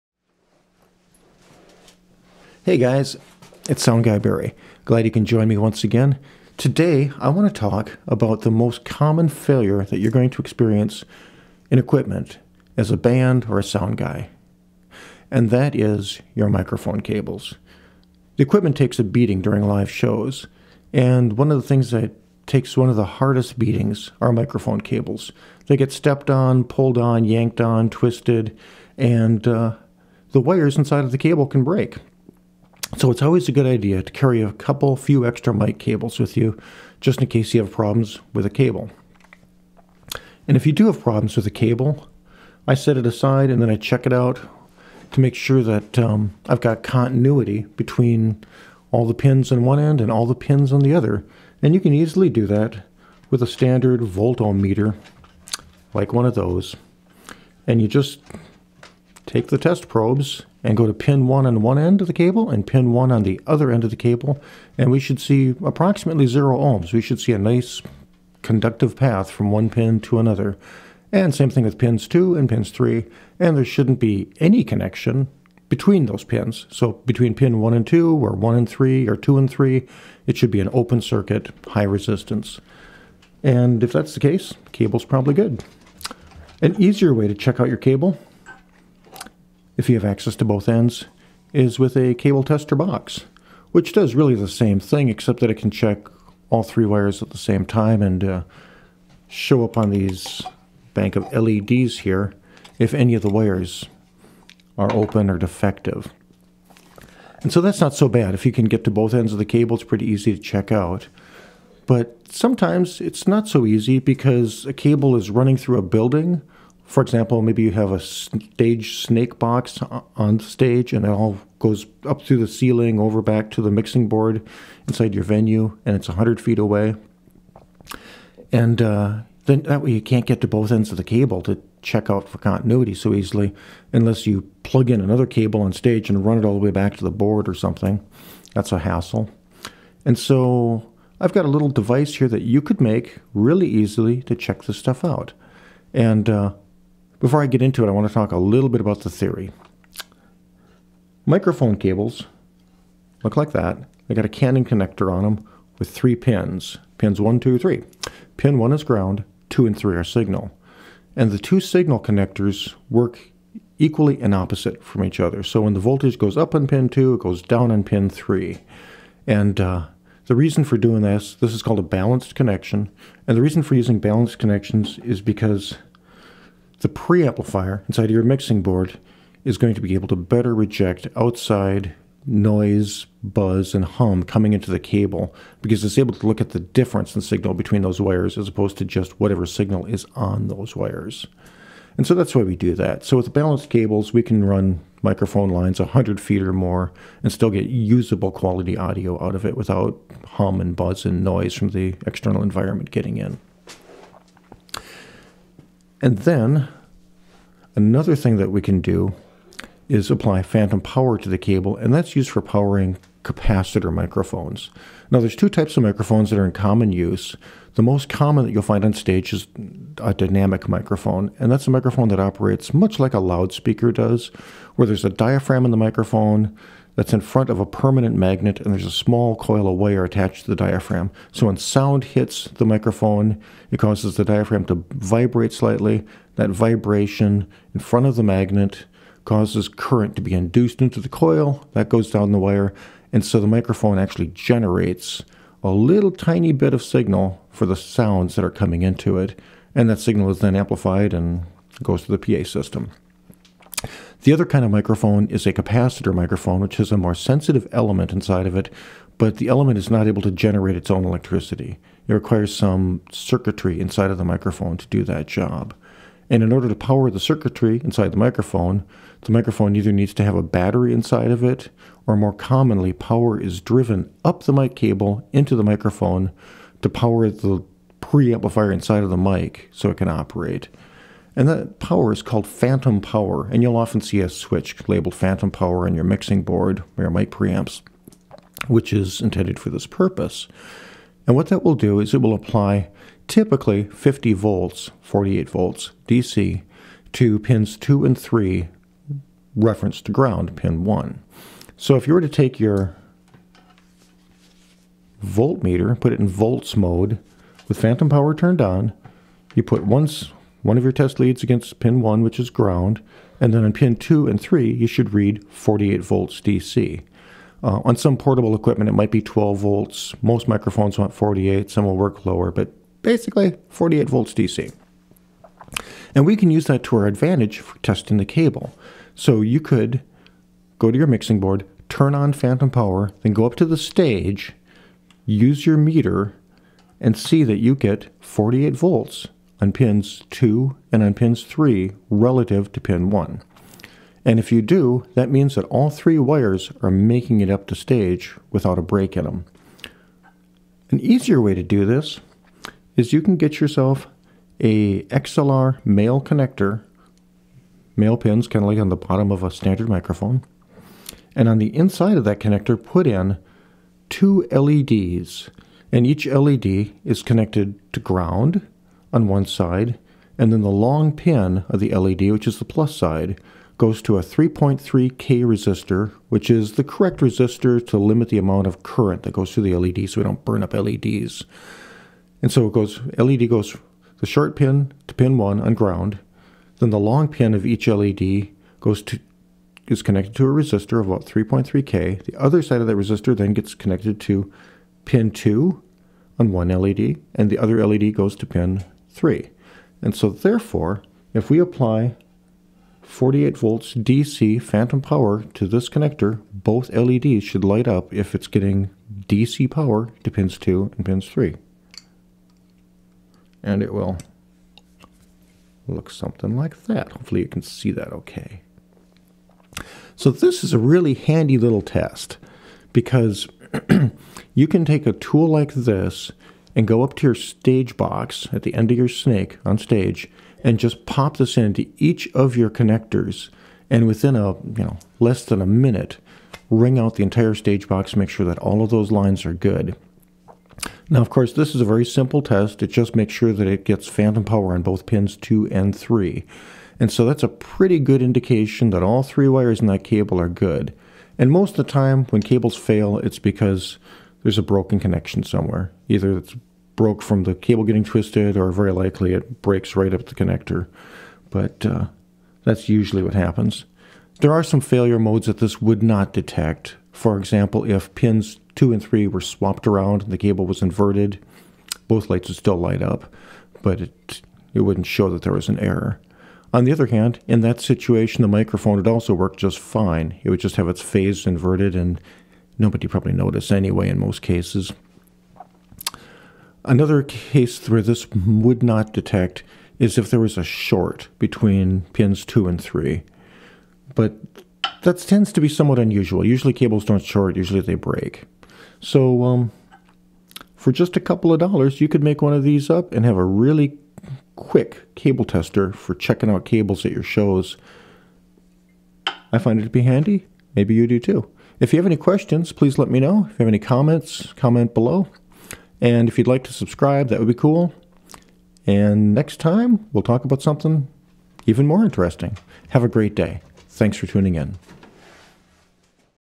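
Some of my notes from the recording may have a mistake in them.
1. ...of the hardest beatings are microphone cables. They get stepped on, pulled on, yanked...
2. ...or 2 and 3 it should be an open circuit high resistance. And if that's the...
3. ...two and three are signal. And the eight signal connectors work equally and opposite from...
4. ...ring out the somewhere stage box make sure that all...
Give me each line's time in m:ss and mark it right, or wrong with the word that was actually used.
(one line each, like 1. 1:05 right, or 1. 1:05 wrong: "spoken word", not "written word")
1. 0:22 right
2. 1:19 right
3. 2:39 wrong: "two", not "eight"
4. 7:16 wrong: "entire", not "somewhere".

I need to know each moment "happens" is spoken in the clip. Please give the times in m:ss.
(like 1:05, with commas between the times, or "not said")
7:43.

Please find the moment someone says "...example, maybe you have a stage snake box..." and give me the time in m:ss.
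1:57.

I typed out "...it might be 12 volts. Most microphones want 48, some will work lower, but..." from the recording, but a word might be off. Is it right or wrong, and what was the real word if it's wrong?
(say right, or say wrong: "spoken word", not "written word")
right.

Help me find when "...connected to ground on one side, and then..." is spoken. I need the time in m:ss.
6:07.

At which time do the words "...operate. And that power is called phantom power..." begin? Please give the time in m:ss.
4:40.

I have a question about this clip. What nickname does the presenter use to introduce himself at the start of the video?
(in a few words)
Sound Guy Barry.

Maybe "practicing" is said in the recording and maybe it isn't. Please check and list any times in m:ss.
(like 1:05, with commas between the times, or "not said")
not said.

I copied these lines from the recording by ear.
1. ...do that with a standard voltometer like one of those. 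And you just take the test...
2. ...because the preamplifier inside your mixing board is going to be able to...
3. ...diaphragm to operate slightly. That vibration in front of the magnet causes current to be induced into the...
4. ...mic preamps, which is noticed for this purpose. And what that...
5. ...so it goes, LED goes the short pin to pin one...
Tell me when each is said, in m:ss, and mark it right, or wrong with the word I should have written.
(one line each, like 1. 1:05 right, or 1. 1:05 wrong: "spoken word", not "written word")
1. 0:52 right
2. 2:55 right
3. 3:54 wrong: "vibrate", not "operate"
4. 4:47 wrong: "intended", not "noticed"
5. 6:22 right.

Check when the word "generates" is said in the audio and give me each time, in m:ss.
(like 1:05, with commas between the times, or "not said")
4:04, 4:20.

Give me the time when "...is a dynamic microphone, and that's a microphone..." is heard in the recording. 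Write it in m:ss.
3:39.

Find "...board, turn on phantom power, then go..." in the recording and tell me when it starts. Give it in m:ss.
5:31.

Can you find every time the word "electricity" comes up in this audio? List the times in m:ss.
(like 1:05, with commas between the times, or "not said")
4:21.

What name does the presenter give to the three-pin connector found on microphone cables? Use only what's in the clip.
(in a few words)
Cannon connector.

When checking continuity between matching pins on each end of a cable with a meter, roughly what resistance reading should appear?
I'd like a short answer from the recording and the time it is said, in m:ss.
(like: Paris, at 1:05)
0 ohms, at 1:06.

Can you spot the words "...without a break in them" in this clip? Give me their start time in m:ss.
5:48.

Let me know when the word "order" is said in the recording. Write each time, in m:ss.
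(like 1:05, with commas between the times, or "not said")
4:26.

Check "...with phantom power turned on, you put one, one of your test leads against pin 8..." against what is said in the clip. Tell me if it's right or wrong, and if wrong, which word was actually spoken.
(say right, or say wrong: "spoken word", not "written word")
wrong: "1", not "8".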